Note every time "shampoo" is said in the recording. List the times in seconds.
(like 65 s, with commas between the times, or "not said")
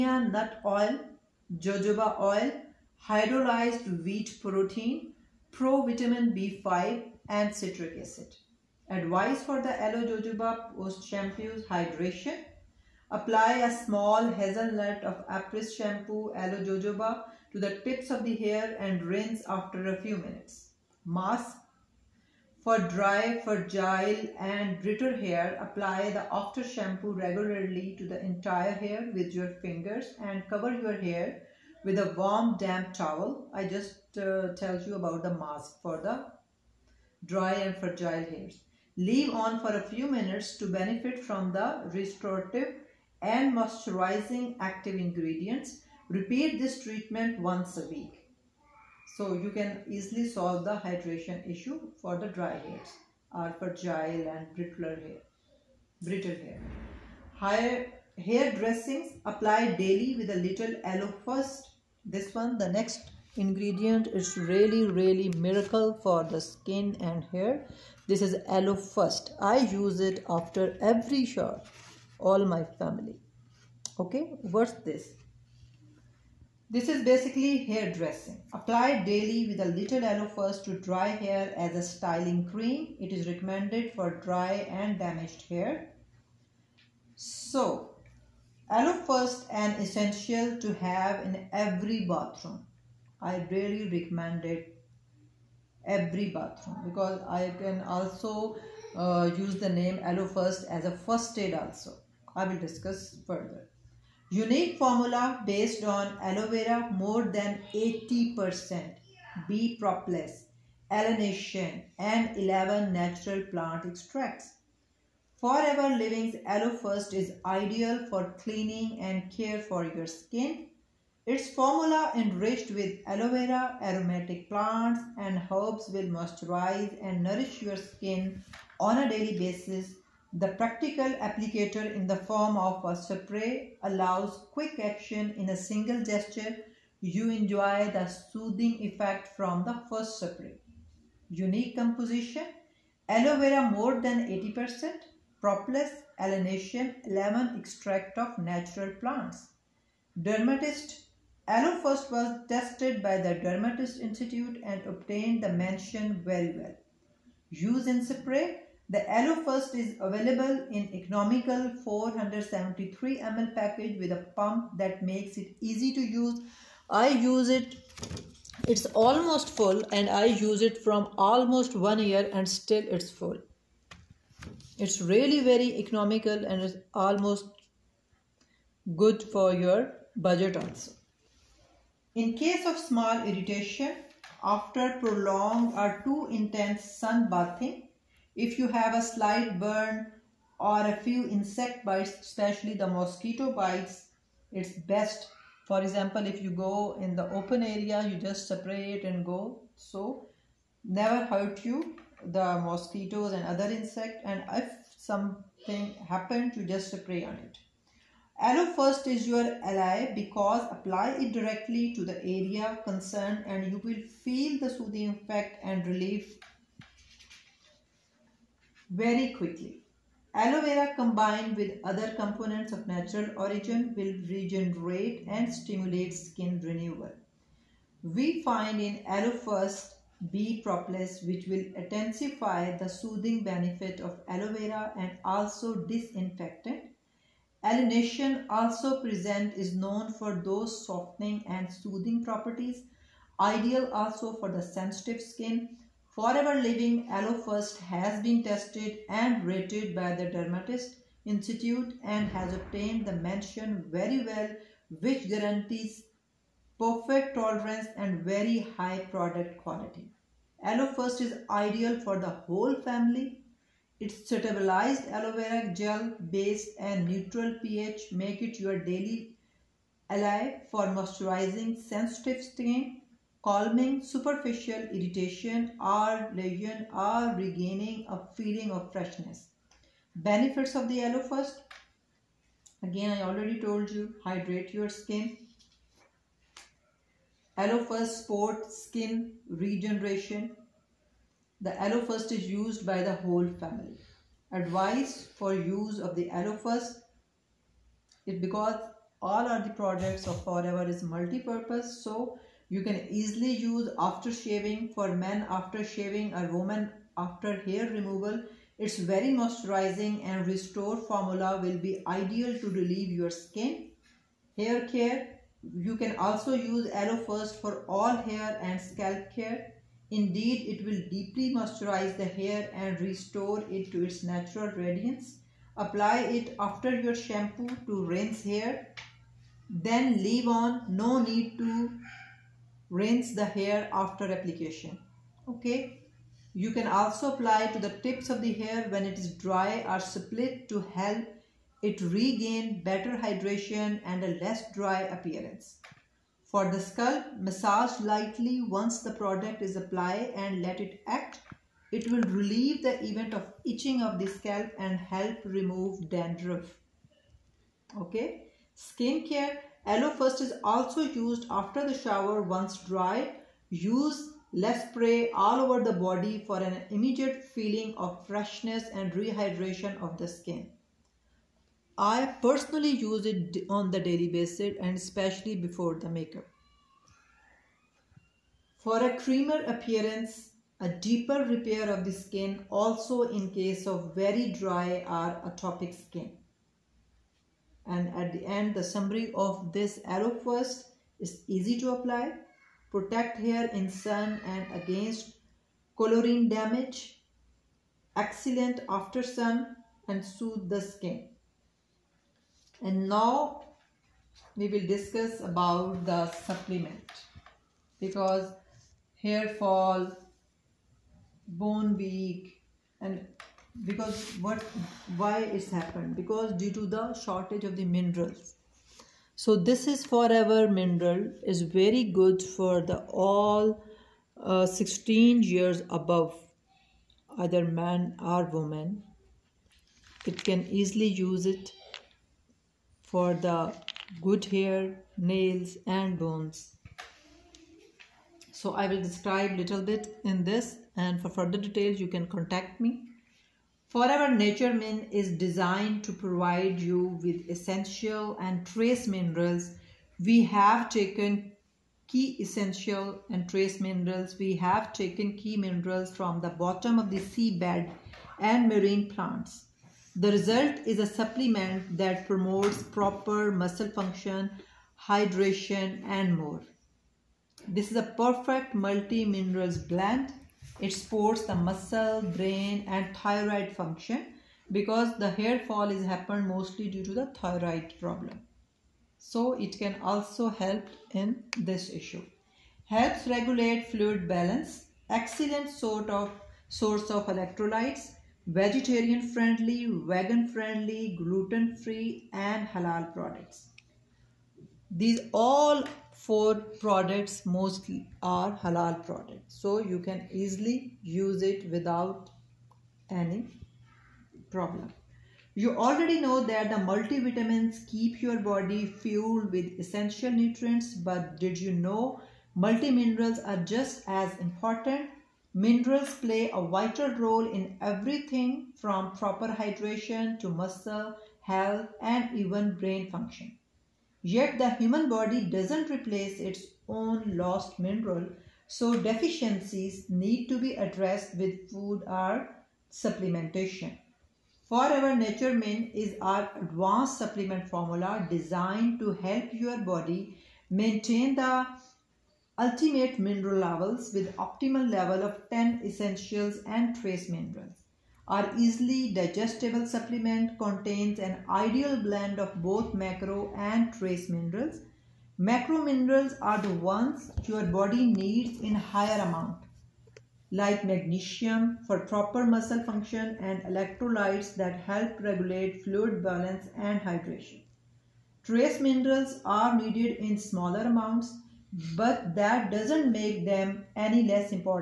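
11 s, 15 s, 26 s, 327 s.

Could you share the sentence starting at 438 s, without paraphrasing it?
So I will describe little bit in this and for further details you can contact me.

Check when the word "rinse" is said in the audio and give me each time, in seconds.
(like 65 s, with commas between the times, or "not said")
19 s, 328 s, 332 s.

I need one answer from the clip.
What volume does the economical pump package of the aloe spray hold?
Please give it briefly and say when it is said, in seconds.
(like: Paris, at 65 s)
473 ml, at 161 s.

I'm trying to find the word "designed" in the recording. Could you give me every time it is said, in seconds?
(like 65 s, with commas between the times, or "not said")
445 s, 538 s.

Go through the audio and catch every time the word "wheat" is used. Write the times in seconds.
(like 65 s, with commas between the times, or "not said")
4 s.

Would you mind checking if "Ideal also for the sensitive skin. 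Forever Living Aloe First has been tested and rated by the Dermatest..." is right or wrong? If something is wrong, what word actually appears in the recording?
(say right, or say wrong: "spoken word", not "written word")
right.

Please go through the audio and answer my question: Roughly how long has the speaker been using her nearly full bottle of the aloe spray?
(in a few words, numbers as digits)
Almost one year.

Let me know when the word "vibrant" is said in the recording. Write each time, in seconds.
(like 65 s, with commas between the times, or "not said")
not said.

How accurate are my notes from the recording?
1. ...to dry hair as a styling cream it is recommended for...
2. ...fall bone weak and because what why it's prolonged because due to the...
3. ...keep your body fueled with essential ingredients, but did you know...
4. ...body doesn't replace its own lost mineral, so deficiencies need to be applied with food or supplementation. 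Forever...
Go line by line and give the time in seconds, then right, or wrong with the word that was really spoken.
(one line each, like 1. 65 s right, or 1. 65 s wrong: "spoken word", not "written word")
1. 80 s right
2. 409 s wrong: "happened", not "prolonged"
3. 507 s wrong: "nutrients", not "ingredients"
4. 525 s wrong: "addressed", not "applied".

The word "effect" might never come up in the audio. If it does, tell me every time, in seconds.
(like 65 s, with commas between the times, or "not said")
138 s, 215 s.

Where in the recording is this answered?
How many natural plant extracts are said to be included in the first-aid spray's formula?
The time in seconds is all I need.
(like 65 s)
112 s.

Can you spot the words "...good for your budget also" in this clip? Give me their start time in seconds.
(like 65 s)
178 s.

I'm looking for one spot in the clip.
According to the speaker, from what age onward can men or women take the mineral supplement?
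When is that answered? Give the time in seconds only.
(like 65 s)
424 s.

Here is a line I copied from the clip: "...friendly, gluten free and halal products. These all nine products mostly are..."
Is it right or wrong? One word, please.
wrong.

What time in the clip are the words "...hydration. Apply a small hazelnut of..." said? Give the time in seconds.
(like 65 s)
11 s.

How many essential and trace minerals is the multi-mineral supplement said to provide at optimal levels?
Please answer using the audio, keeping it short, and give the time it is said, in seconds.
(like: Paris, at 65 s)
10, at 545 s.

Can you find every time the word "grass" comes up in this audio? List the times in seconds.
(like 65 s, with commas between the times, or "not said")
not said.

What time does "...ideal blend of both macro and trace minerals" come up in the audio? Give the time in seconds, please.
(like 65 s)
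551 s.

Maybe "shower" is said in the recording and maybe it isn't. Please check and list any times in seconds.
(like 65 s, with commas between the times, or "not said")
71 s, 361 s.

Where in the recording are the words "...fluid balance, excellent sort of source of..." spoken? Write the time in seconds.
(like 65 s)
483 s.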